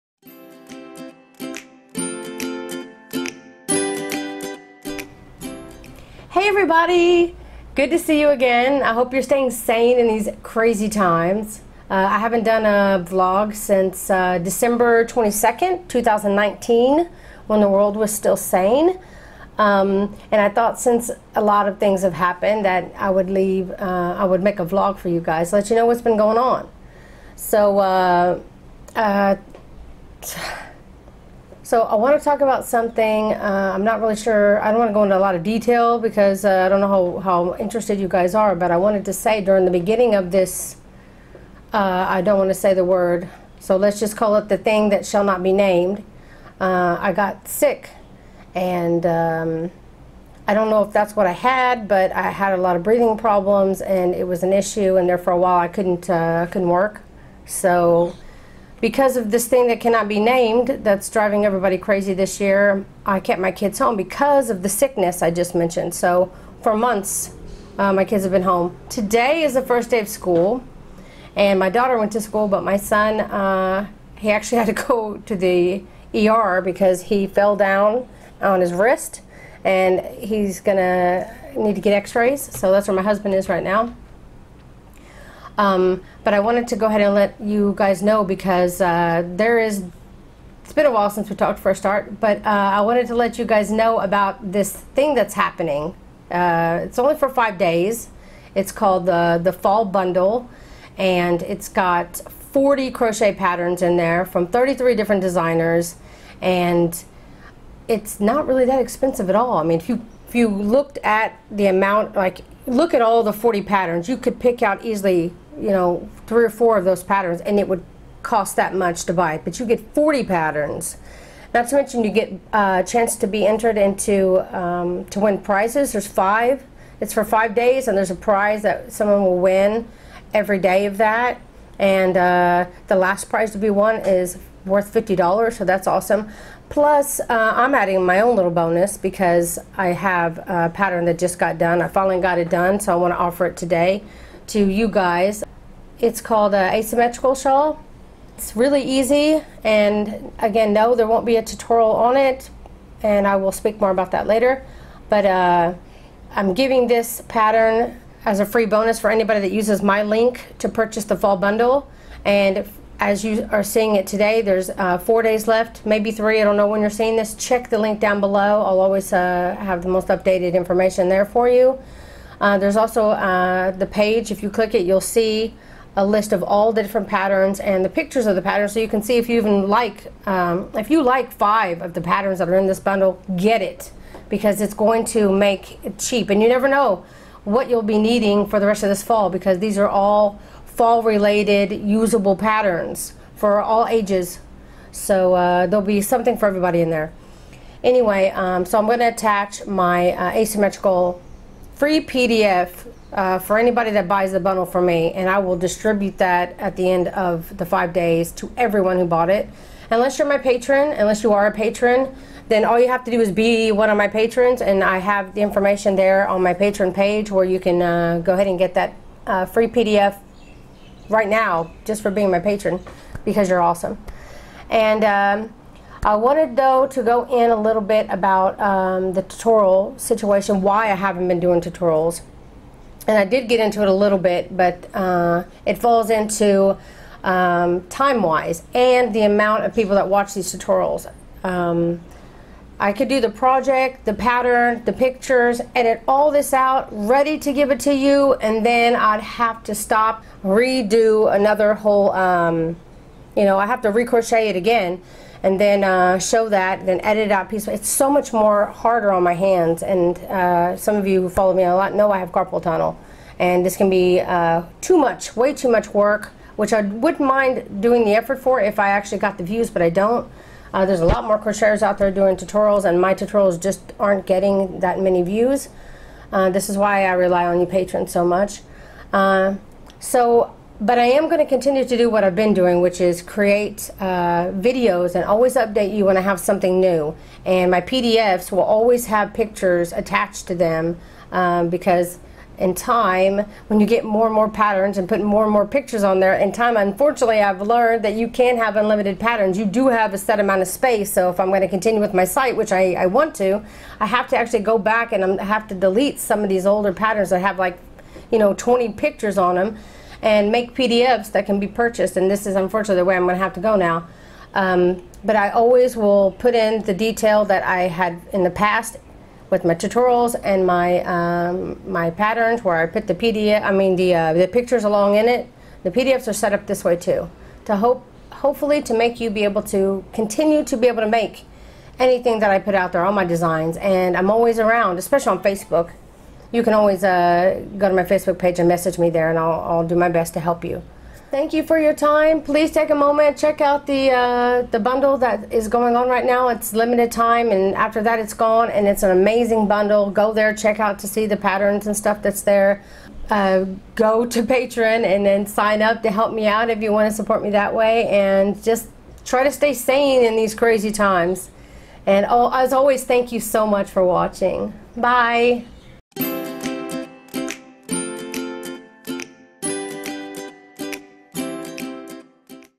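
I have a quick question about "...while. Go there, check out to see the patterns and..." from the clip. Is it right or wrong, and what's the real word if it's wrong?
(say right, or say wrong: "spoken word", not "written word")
wrong: "bundle", not "while".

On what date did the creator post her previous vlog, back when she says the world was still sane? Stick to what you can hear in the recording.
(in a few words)
December 22nd, 2019.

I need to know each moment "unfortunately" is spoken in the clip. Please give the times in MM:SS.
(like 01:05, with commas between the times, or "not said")
04:56, 05:12.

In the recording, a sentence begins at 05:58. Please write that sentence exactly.
And just try to stay sane in these crazy times.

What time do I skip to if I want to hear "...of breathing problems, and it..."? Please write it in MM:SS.
00:52.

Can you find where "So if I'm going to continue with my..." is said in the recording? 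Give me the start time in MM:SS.
05:01.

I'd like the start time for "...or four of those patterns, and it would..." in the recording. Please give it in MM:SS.
01:56.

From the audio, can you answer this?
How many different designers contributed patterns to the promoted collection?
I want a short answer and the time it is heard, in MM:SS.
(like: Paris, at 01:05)
33, at 01:44.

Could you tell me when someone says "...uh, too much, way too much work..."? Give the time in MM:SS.
04:24.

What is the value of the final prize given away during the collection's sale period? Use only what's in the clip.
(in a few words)
$50.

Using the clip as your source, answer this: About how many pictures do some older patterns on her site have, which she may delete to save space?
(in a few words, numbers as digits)
20.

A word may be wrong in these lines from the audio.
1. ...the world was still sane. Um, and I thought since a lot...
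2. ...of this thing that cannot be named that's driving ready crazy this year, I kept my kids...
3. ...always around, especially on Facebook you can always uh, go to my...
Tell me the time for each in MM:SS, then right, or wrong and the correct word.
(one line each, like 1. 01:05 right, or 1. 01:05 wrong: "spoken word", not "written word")
1. 00:17 right
2. 00:59 wrong: "everybody", not "ready"
3. 05:34 right.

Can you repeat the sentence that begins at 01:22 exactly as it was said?
So that's where my husband is right now.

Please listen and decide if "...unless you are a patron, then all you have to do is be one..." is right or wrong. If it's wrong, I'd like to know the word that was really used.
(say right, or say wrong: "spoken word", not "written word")
right.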